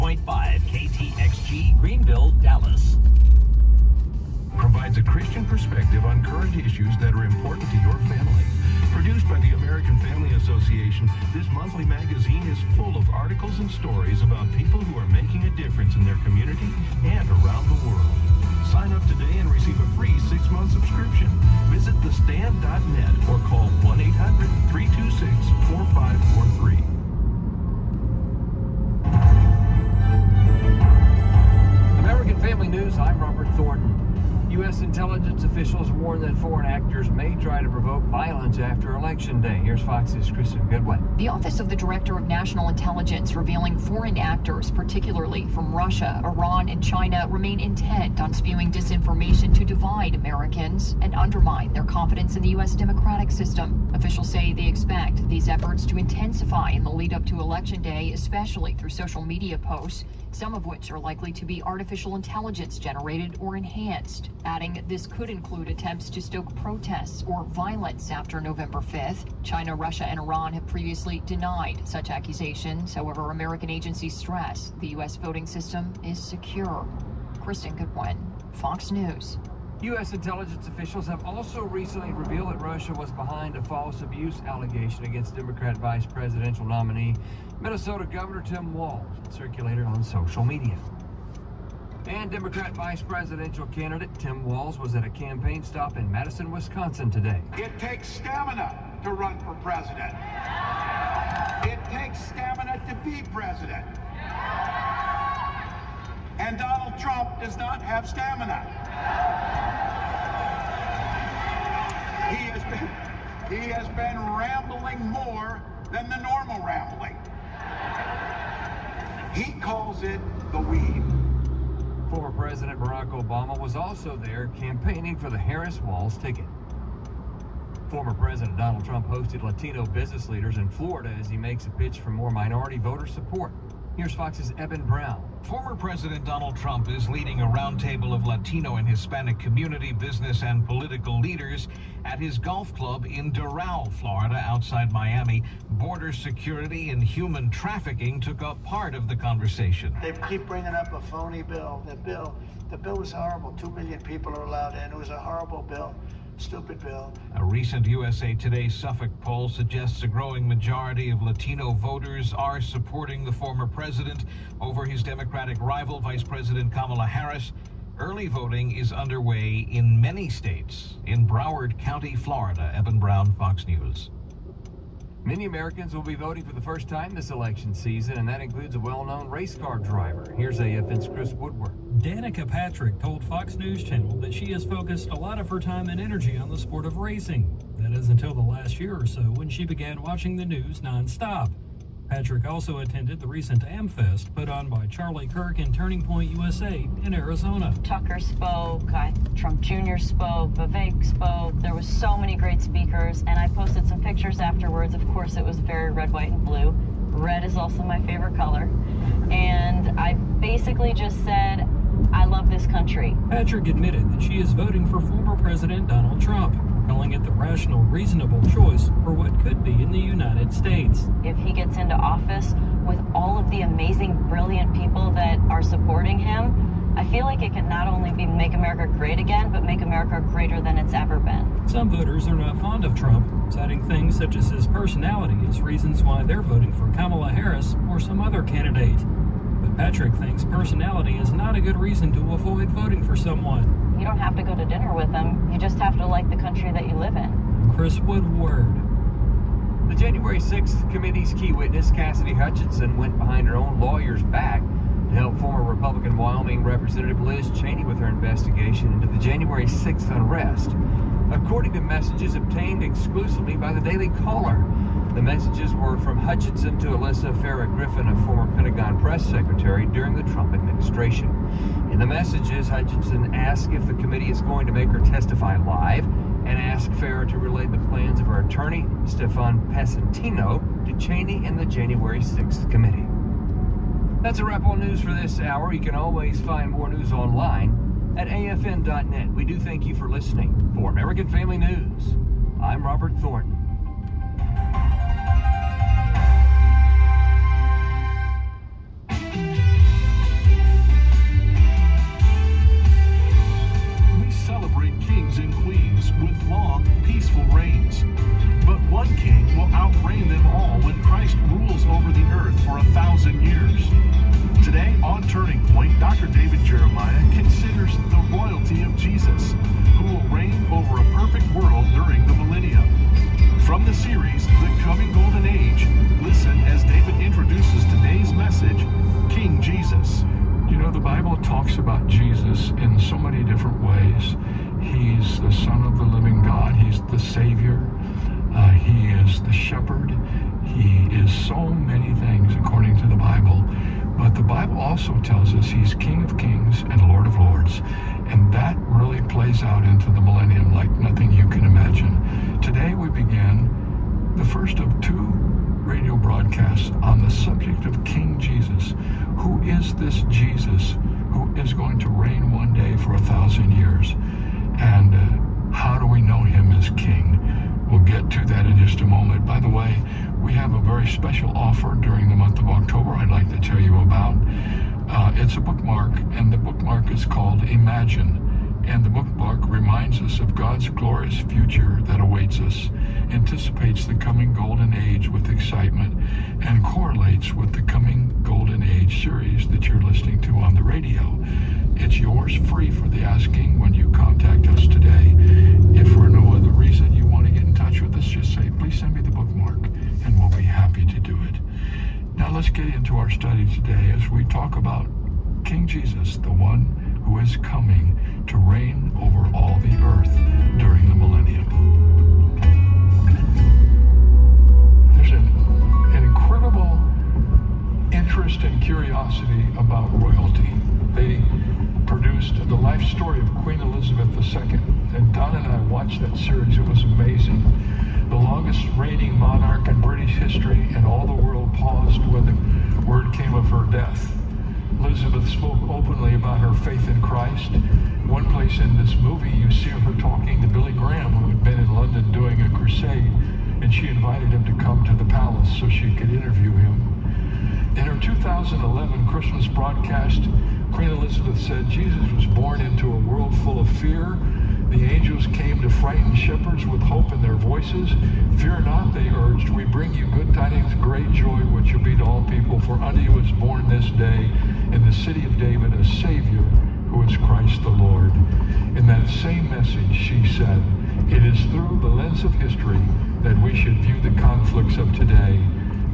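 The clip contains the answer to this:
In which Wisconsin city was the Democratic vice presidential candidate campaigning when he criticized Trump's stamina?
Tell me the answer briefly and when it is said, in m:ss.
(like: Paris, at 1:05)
Madison, at 1:36.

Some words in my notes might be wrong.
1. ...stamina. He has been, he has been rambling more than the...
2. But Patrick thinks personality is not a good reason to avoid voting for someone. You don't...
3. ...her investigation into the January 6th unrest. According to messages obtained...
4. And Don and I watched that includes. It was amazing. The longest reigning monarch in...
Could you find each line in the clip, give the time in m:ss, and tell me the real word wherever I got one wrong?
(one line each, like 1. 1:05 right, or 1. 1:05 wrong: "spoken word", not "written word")
1. 1:48 right
2. 3:59 right
3. 4:17 right
4. 7:05 wrong: "series", not "includes".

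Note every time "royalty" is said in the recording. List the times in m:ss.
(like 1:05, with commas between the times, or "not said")
7:00.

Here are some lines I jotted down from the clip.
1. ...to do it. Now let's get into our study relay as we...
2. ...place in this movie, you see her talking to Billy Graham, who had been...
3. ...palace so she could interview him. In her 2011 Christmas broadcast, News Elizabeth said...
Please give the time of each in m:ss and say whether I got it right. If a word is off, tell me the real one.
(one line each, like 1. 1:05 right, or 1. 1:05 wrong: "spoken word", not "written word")
1. 6:41 wrong: "today", not "relay"
2. 7:18 right
3. 7:25 wrong: "Queen", not "News".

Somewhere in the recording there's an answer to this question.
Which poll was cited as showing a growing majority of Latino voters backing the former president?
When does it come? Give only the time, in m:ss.
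2:37.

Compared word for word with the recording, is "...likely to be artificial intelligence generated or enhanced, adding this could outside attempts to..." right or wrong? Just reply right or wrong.
wrong.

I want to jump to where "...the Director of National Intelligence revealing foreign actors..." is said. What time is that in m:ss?
0:41.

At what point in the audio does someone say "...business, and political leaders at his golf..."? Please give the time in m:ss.
2:19.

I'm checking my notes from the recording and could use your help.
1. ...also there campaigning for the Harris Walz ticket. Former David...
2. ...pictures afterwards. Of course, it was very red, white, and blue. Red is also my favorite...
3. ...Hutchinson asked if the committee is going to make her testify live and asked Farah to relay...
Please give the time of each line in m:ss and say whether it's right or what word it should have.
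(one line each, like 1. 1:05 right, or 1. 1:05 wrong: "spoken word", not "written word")
1. 2:03 wrong: "President", not "David"
2. 3:23 right
3. 4:32 right.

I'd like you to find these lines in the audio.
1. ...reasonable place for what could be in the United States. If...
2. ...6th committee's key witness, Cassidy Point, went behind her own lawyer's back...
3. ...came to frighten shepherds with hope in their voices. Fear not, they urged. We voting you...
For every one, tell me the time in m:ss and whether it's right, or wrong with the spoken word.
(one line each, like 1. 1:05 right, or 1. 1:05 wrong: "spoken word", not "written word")
1. 3:37 wrong: "choice", not "place"
2. 4:10 wrong: "Hutchinson", not "Point"
3. 7:35 wrong: "bring", not "voting".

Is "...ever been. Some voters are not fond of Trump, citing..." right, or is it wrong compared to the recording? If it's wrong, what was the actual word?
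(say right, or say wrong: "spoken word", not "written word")
right.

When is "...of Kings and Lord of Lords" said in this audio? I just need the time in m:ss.
5:46.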